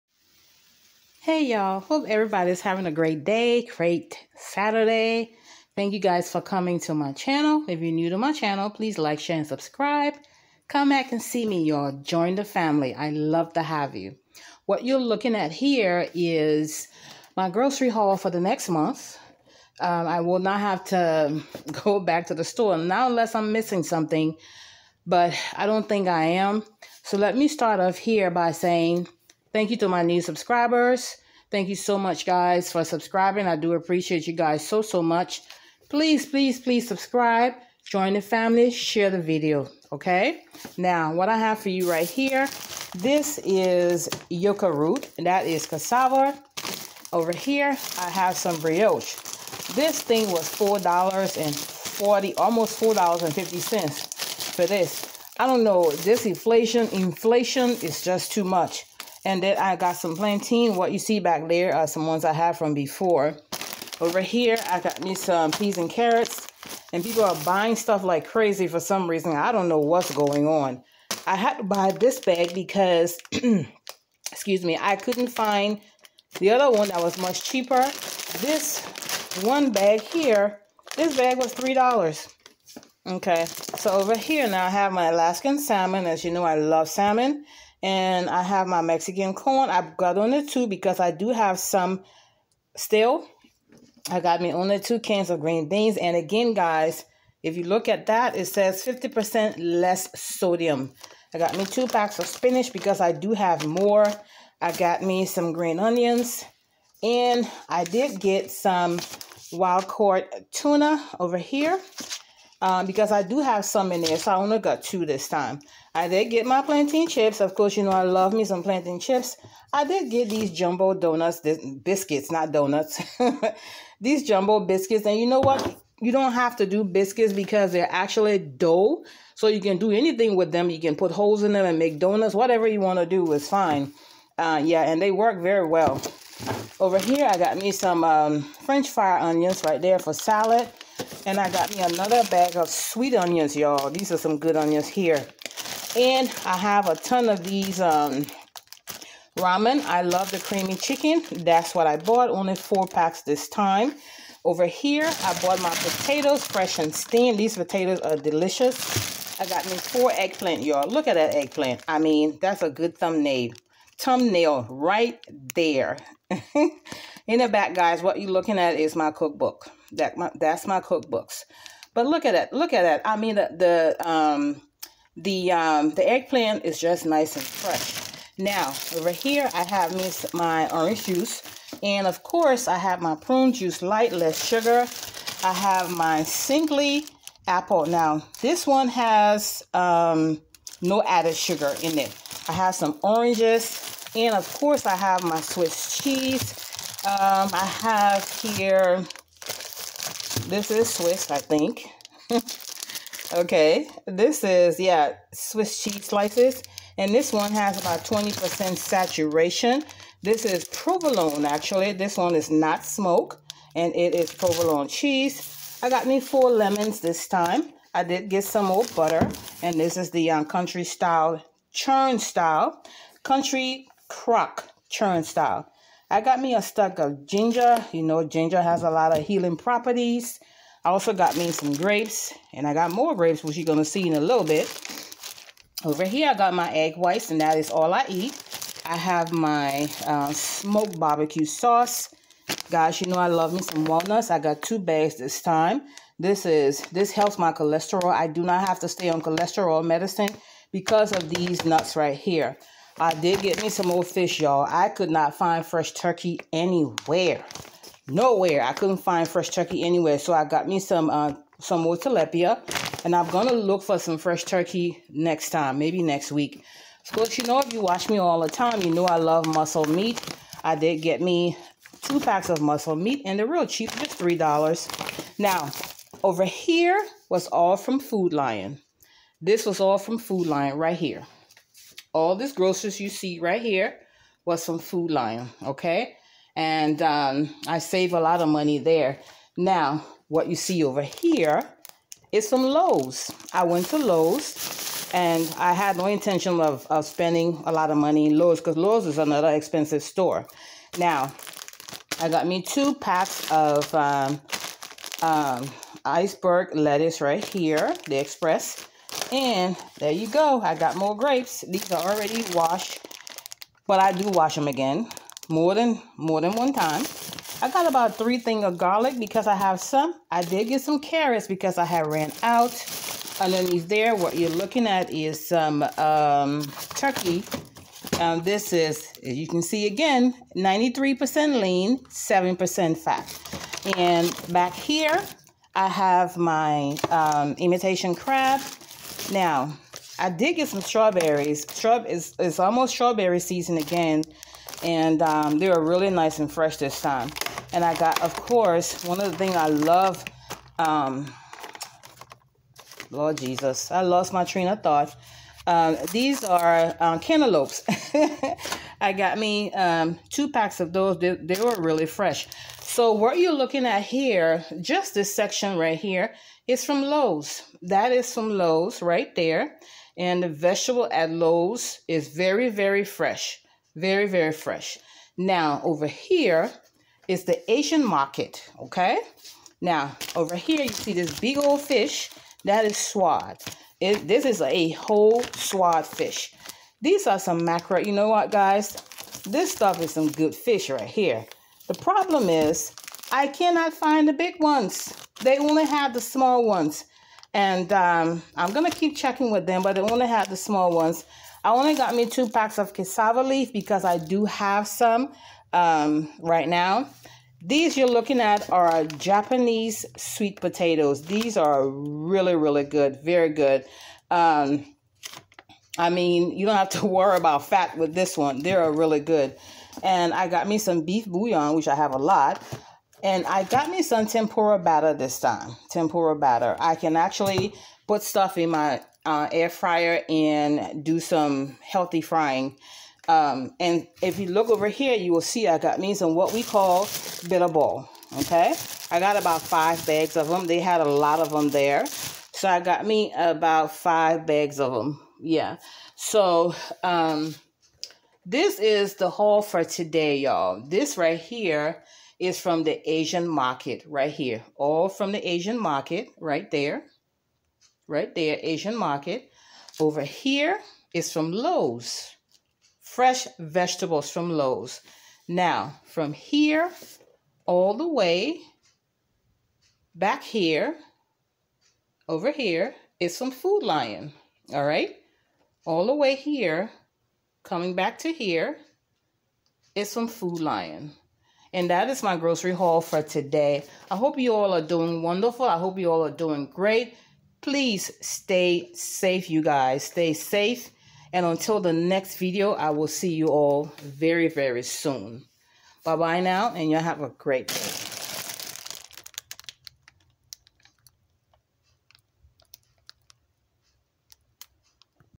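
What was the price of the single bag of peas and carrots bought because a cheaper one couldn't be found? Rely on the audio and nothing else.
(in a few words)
$3.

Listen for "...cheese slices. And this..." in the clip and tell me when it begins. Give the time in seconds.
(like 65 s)
205 s.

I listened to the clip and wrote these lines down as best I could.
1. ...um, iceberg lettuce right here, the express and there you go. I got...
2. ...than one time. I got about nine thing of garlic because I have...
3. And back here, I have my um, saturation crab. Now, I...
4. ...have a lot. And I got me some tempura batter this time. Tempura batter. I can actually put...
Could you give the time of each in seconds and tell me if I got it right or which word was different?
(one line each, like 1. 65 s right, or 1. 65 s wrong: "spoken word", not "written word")
1. 305 s right
2. 316 s wrong: "three", not "nine"
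3. 333 s wrong: "imitation", not "saturation"
4. 421 s right.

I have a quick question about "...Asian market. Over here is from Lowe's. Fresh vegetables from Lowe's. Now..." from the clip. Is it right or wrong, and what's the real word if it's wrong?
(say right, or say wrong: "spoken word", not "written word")
right.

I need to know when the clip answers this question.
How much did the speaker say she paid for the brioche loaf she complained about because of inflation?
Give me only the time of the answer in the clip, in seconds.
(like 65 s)
50 s.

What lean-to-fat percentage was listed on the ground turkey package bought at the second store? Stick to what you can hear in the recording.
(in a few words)
93% lean.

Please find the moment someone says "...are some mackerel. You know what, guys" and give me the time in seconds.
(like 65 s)
387 s.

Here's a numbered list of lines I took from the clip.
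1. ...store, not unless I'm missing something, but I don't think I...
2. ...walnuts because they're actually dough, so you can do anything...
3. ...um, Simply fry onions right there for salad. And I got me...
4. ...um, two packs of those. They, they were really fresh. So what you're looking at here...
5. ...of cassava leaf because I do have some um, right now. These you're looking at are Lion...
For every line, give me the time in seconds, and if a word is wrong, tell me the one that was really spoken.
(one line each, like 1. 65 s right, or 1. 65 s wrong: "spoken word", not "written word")
1. 22 s right
2. 126 s wrong: "biscuits", not "walnuts"
3. 138 s wrong: "French", not "Simply"
4. 359 s right
5. 402 s wrong: "Japanese", not "Lion".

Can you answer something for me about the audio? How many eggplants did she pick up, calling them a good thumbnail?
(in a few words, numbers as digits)
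4.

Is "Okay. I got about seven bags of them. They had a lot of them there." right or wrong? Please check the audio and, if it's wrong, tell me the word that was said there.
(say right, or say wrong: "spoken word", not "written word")
wrong: "five", not "seven".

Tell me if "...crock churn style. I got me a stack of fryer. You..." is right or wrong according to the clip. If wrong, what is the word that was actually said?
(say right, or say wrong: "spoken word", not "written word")
wrong: "ginger", not "fryer".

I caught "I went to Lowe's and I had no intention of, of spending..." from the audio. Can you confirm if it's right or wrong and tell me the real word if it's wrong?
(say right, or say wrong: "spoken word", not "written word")
right.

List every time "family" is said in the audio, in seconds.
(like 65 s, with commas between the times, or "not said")
12 s, 38 s.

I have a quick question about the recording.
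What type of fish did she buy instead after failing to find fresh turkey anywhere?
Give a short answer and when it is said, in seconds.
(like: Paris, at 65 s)
Tilapia, at 261 s.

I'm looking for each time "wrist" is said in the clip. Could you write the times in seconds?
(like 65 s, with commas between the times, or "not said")
not said.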